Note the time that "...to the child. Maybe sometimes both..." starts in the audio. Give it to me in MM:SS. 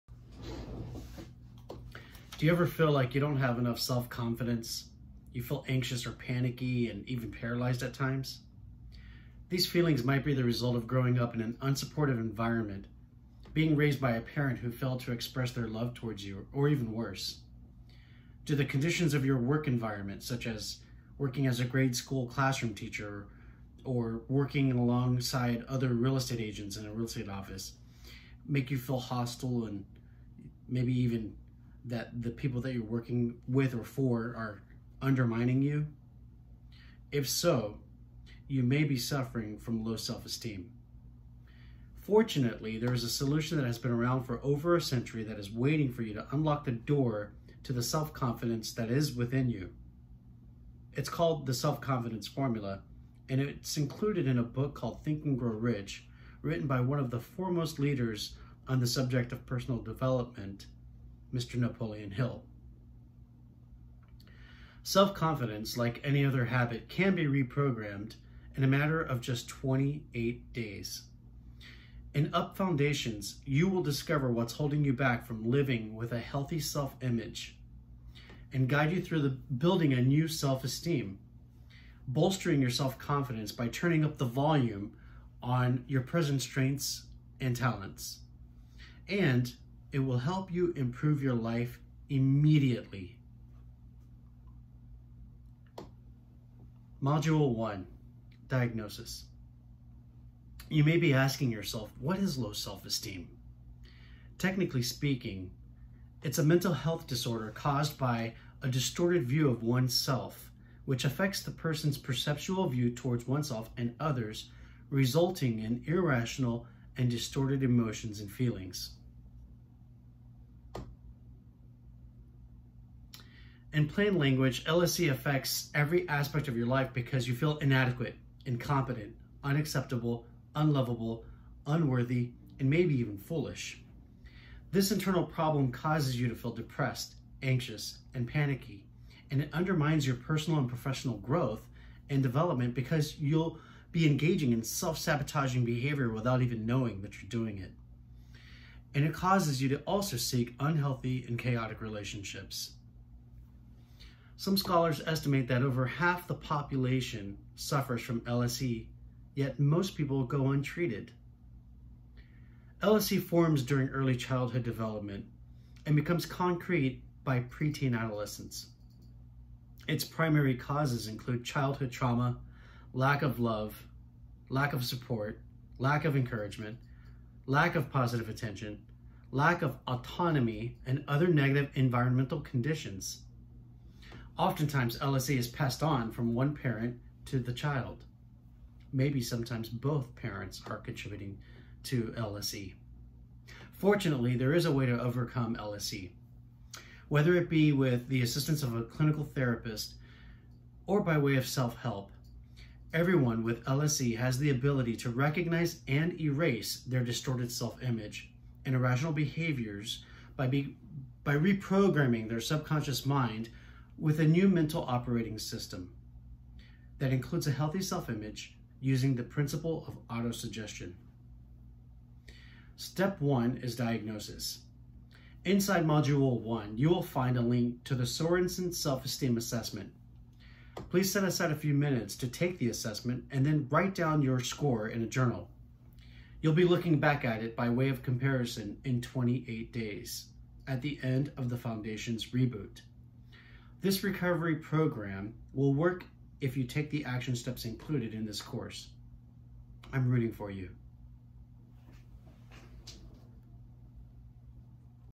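03:07.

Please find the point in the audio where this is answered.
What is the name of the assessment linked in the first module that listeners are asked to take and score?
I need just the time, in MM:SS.
03:48.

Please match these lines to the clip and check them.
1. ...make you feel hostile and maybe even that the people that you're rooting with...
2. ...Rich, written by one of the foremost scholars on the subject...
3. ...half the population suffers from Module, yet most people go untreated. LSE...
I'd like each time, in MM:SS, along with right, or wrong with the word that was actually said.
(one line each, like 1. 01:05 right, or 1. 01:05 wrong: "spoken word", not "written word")
1. 00:28 wrong: "working", not "rooting"
2. 00:55 wrong: "leaders", not "scholars"
3. 02:35 wrong: "LSE", not "Module".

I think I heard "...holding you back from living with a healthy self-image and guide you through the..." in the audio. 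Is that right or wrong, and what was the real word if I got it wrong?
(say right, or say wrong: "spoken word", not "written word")
right.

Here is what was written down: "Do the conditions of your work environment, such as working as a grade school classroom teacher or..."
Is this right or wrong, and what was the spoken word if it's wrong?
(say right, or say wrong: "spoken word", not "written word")
right.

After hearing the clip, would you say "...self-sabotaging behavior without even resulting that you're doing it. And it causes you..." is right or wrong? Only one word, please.
wrong.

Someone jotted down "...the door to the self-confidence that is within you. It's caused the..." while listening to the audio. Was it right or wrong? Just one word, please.
wrong.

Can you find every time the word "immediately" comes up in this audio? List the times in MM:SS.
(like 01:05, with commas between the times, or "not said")
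01:32.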